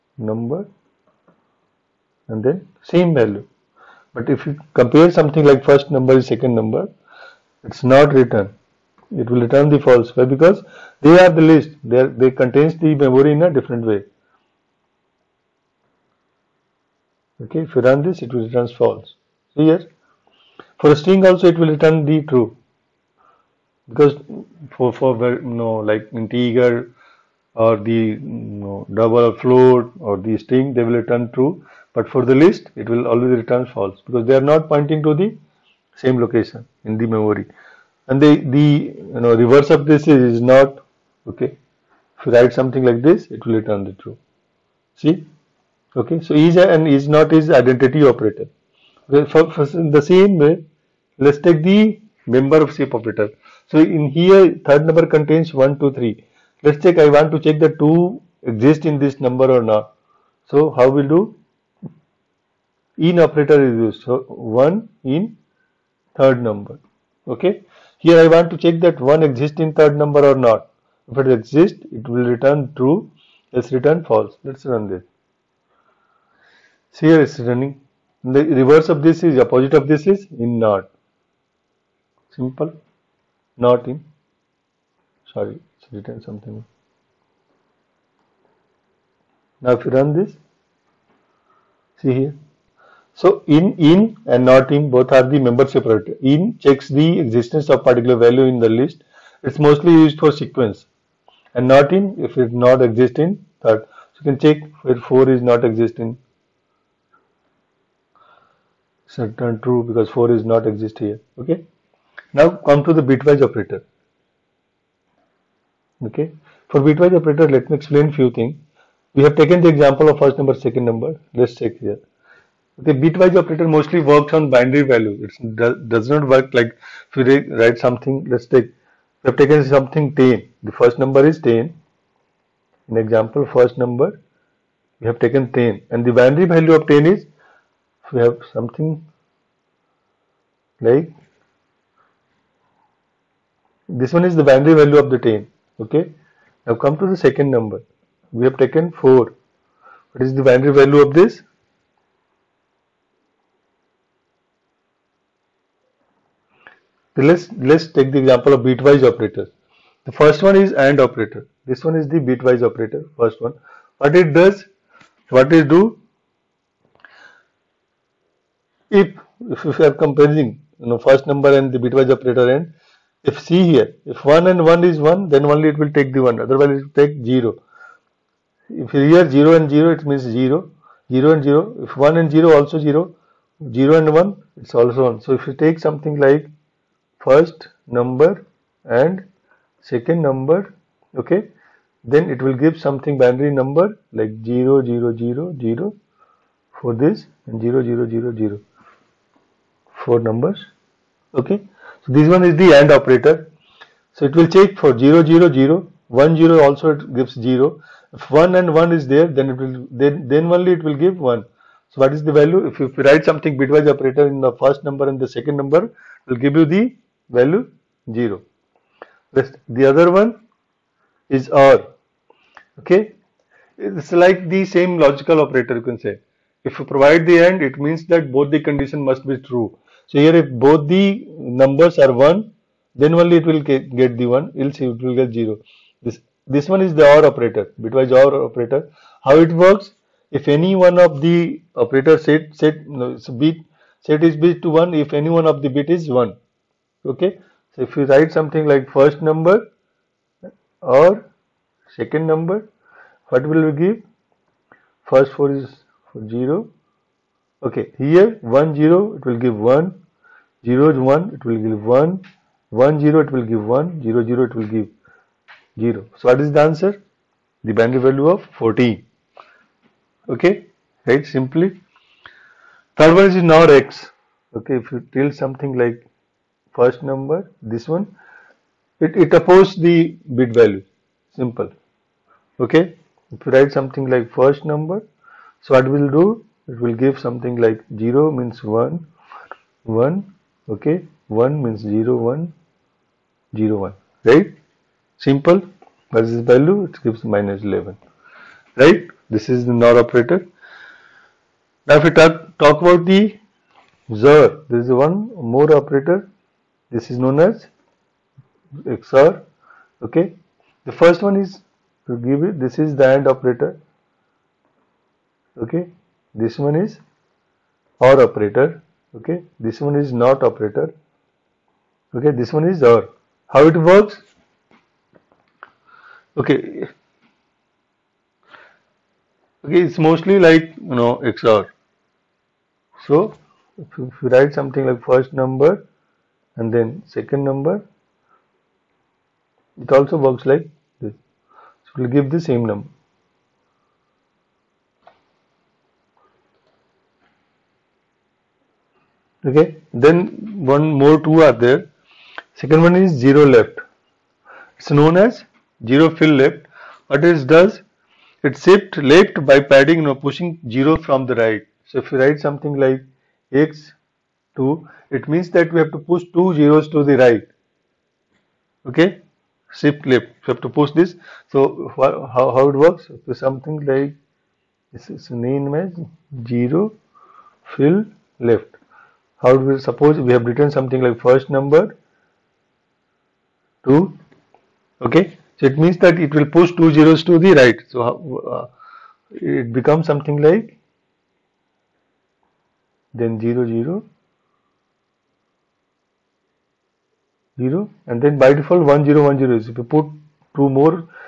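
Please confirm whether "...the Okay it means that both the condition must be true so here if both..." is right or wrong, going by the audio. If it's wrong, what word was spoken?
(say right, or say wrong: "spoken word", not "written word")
wrong: "AND", not "Okay".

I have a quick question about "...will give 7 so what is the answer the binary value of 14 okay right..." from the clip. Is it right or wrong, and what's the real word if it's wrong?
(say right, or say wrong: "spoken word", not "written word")
wrong: "0", not "7".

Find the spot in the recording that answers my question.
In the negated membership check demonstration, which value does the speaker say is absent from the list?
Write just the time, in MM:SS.
01:44.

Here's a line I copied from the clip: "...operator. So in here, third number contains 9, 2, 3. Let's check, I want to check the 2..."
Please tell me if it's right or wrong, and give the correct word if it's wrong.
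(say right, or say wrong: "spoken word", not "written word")
wrong: "1", not "9".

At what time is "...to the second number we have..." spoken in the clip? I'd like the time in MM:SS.
02:26.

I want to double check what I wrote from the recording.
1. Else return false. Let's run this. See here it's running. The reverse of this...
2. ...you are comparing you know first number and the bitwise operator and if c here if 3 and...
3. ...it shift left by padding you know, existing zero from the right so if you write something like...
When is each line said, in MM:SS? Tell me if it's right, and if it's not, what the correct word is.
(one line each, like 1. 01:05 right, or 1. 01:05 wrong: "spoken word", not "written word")
1. 01:13 right
2. 02:49 wrong: "1", not "3"
3. 05:58 wrong: "pushing", not "existing".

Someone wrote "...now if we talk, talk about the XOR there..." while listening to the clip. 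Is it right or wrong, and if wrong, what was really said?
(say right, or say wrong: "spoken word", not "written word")
right.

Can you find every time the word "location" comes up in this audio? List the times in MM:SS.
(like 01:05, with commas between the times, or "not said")
00:36.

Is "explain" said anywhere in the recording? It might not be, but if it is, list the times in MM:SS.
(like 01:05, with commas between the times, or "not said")
01:57.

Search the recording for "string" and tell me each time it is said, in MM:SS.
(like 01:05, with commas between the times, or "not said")
00:20, 00:30.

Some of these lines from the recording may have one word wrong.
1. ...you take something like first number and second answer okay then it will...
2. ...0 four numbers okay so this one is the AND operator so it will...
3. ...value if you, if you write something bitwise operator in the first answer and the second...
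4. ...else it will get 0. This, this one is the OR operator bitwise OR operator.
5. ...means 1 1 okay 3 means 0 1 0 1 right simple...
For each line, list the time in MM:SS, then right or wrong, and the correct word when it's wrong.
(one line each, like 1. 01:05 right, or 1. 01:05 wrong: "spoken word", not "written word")
1. 03:05 wrong: "number", not "answer"
2. 03:18 right
3. 03:32 wrong: "number", not "answer"
4. 03:54 right
5. 04:48 wrong: "1", not "3".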